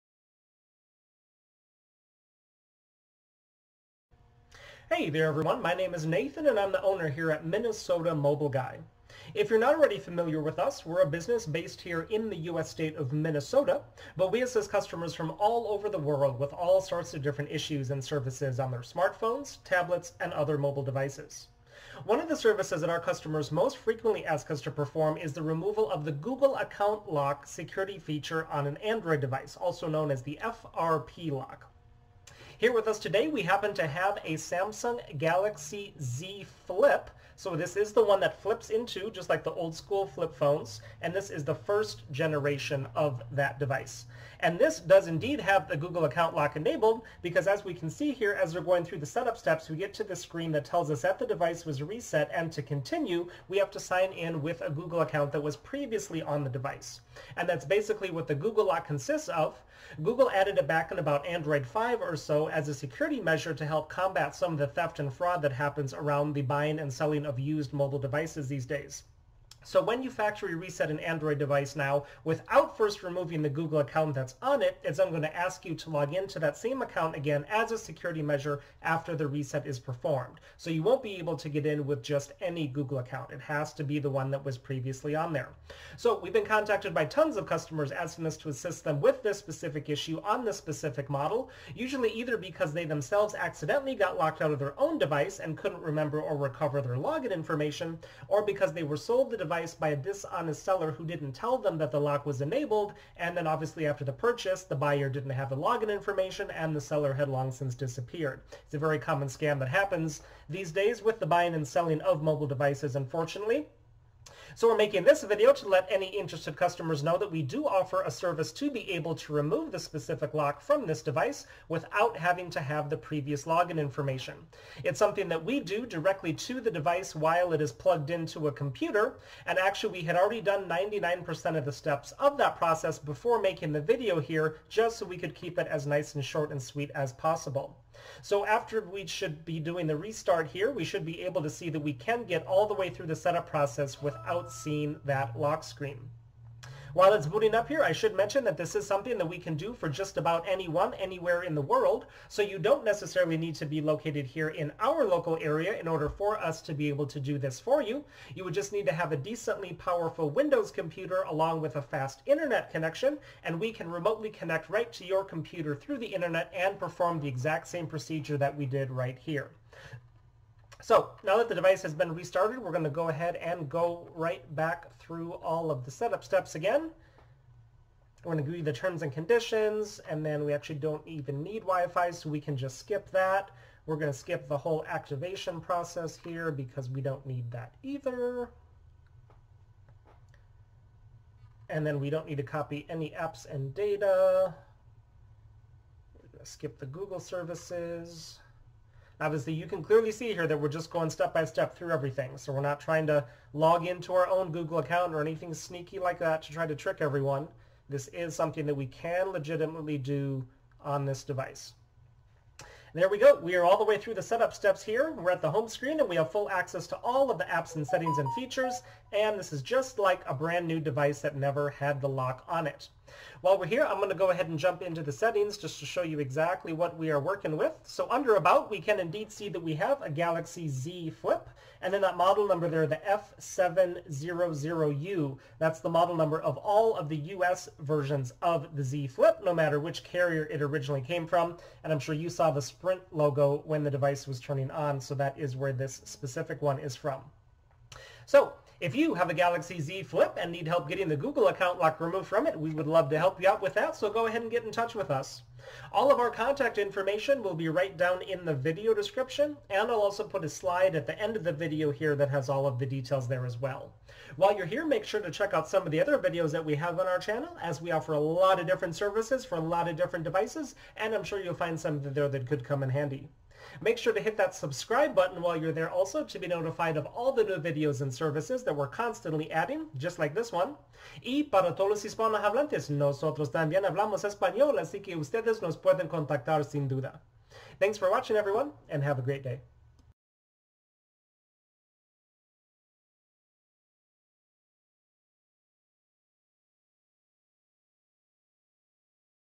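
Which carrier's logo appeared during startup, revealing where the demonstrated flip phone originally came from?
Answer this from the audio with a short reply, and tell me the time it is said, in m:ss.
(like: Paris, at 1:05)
Sprint, at 4:02.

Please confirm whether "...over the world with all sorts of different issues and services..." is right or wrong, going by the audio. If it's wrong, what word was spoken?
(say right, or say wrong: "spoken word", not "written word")
right.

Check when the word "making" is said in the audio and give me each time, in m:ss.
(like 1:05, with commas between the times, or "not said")
1:54, 2:13.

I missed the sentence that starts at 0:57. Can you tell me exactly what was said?
And that's basically what the Google lock consists of.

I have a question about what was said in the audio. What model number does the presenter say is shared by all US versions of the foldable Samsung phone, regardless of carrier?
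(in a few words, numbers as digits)
F700U.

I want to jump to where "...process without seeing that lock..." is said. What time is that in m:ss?
2:23.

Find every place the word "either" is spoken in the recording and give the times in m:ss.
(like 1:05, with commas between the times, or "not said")
1:32, 3:07.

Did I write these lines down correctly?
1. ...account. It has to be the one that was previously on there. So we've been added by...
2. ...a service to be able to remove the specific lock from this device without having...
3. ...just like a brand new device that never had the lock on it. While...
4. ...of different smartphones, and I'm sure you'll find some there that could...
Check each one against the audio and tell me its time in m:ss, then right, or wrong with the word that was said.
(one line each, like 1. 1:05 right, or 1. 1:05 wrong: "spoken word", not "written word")
1. 1:22 wrong: "contacted", not "added"
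2. 1:58 right
3. 3:39 right
4. 4:29 wrong: "devices", not "smartphones".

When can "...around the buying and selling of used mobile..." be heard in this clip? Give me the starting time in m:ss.
1:05.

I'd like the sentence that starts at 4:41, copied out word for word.
Y para todos los hispanohablantes, nosotros también hablamos español, así que ustedes nos pueden contactar sin duda.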